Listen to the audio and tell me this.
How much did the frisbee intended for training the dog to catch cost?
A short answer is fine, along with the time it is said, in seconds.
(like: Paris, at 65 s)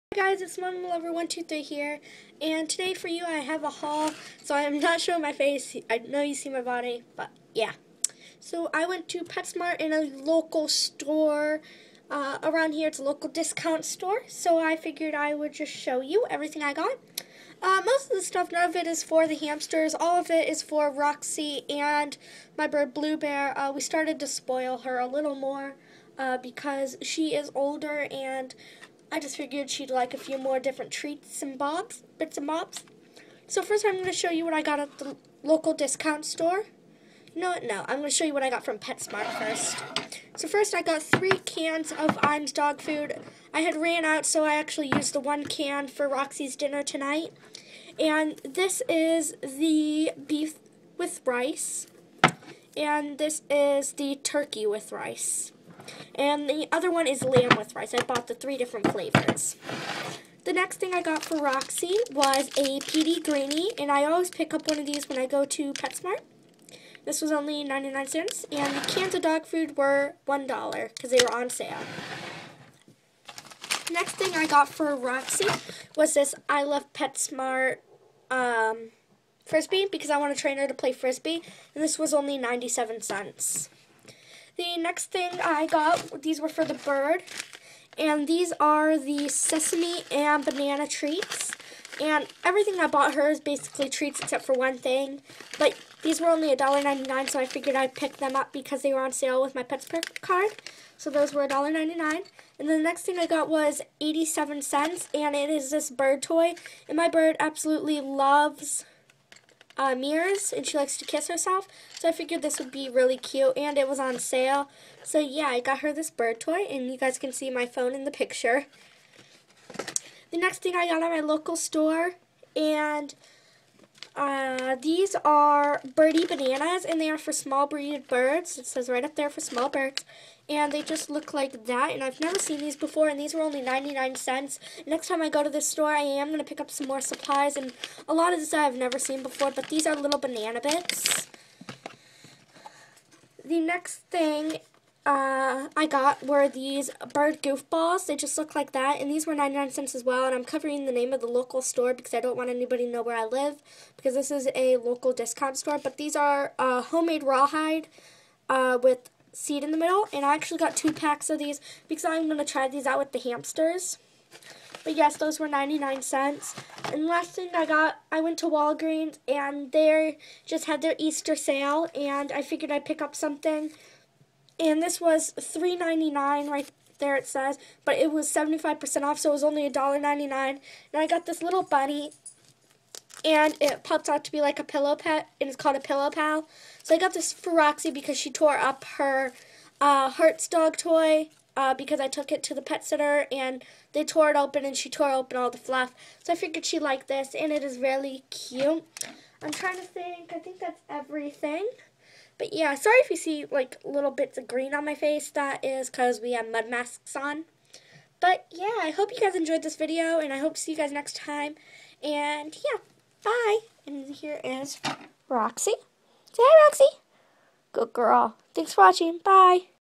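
97 cents, at 82 s.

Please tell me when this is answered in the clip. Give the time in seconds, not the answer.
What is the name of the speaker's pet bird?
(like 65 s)
22 s.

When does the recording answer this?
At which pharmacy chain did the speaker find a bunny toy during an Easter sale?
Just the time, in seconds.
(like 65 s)
168 s.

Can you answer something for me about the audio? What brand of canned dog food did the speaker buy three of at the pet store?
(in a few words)
Iams.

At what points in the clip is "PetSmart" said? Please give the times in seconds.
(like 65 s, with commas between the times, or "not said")
9 s, 38 s, 65 s, 76 s.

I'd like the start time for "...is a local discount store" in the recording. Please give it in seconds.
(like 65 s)
154 s.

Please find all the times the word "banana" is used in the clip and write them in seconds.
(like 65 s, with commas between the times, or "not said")
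90 s, 126 s, 140 s.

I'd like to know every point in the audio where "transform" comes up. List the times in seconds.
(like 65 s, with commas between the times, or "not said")
not said.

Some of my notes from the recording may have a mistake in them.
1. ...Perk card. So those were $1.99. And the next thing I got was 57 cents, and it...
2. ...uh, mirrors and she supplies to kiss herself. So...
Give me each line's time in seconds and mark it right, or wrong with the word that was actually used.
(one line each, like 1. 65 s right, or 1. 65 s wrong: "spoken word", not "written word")
1. 99 s wrong: "87", not "57"
2. 109 s wrong: "likes", not "supplies".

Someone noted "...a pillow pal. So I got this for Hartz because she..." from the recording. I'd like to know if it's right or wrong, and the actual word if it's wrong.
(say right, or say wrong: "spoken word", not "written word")
wrong: "Roxy", not "Hartz".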